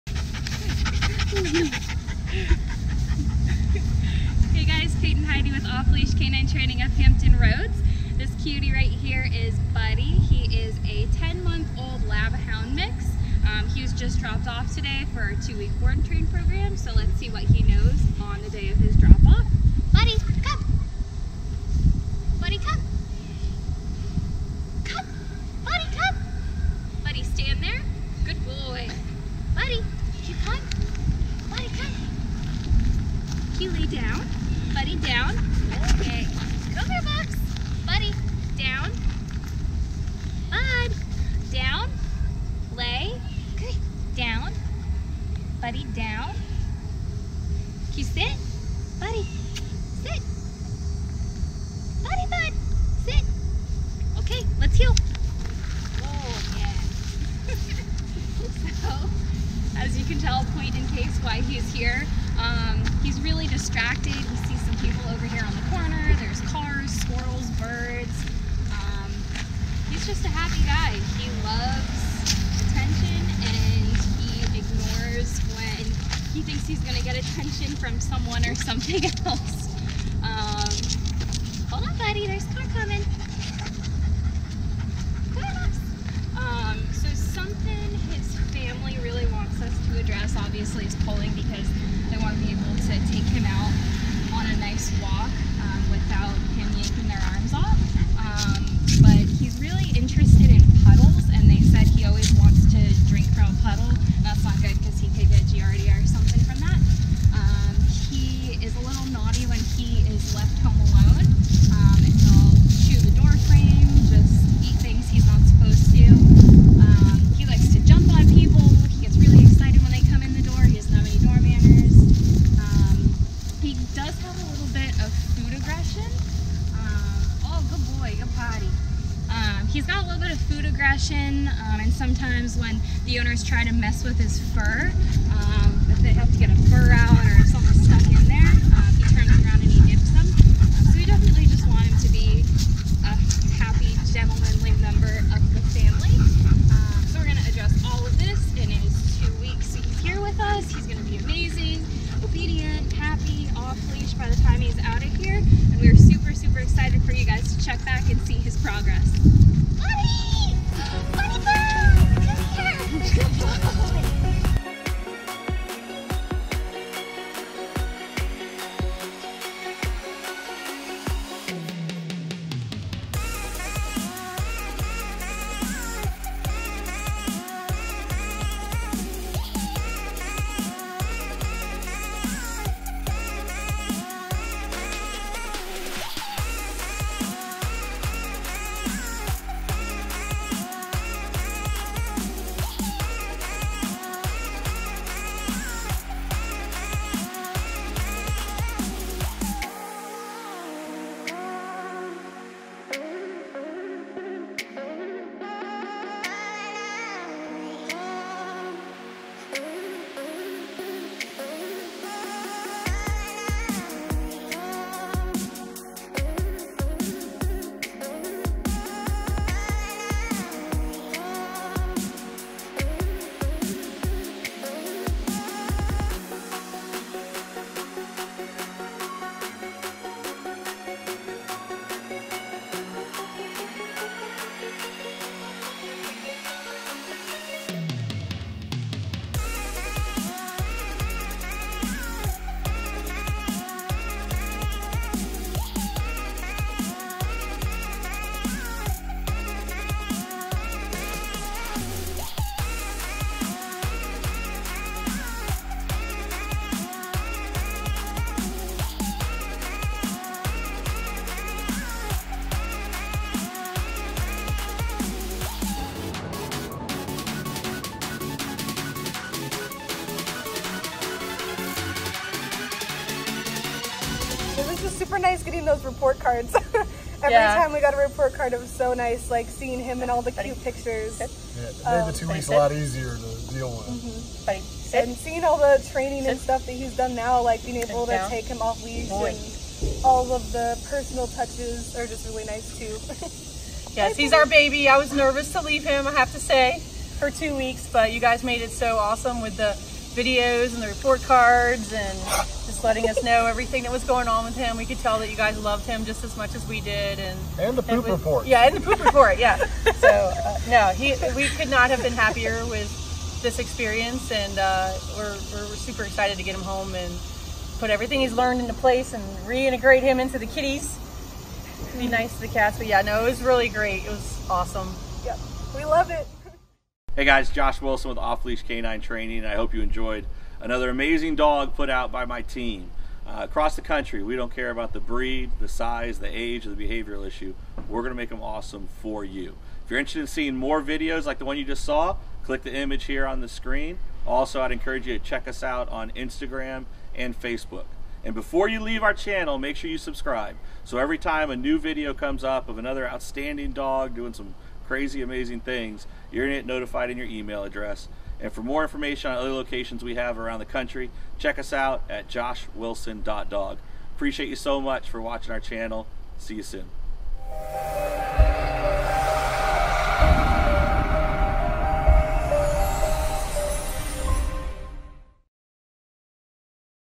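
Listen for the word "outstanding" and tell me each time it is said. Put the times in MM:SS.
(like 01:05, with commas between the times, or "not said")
05:53.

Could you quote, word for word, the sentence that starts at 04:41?
Yeah, it um, made the two weeks a lot easier to deal with.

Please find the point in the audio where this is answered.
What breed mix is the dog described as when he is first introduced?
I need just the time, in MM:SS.
00:12.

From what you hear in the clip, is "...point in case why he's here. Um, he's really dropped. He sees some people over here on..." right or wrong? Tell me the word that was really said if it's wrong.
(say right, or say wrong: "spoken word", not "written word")
wrong: "distracted", not "dropped".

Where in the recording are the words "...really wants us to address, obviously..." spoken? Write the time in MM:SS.
01:29.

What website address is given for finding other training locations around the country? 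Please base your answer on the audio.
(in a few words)
joshwilson.dog.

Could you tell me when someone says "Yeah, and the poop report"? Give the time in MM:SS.
05:08.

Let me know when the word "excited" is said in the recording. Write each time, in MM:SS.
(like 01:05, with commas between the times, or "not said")
02:36, 05:16.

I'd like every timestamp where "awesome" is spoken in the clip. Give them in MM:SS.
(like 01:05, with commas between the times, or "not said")
04:58, 05:24, 05:38.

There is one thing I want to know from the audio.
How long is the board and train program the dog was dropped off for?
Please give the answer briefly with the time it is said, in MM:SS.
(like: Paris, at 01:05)
2 weeks, at 00:15.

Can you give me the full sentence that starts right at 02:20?
So we definitely just want him to be a happy, gentlemanly member of the family.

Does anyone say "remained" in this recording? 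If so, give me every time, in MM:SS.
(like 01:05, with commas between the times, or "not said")
not said.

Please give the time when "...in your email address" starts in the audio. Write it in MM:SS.
05:57.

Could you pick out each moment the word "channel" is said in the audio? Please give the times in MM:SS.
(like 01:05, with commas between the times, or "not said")
05:49, 06:05.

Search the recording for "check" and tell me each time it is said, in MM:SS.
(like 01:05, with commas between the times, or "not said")
02:37, 05:45, 06:01.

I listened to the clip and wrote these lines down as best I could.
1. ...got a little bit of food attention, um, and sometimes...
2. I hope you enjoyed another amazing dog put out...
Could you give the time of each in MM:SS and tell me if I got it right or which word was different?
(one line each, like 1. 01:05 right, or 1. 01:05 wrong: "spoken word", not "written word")
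1. 02:09 wrong: "aggression", not "attention"
2. 05:29 right.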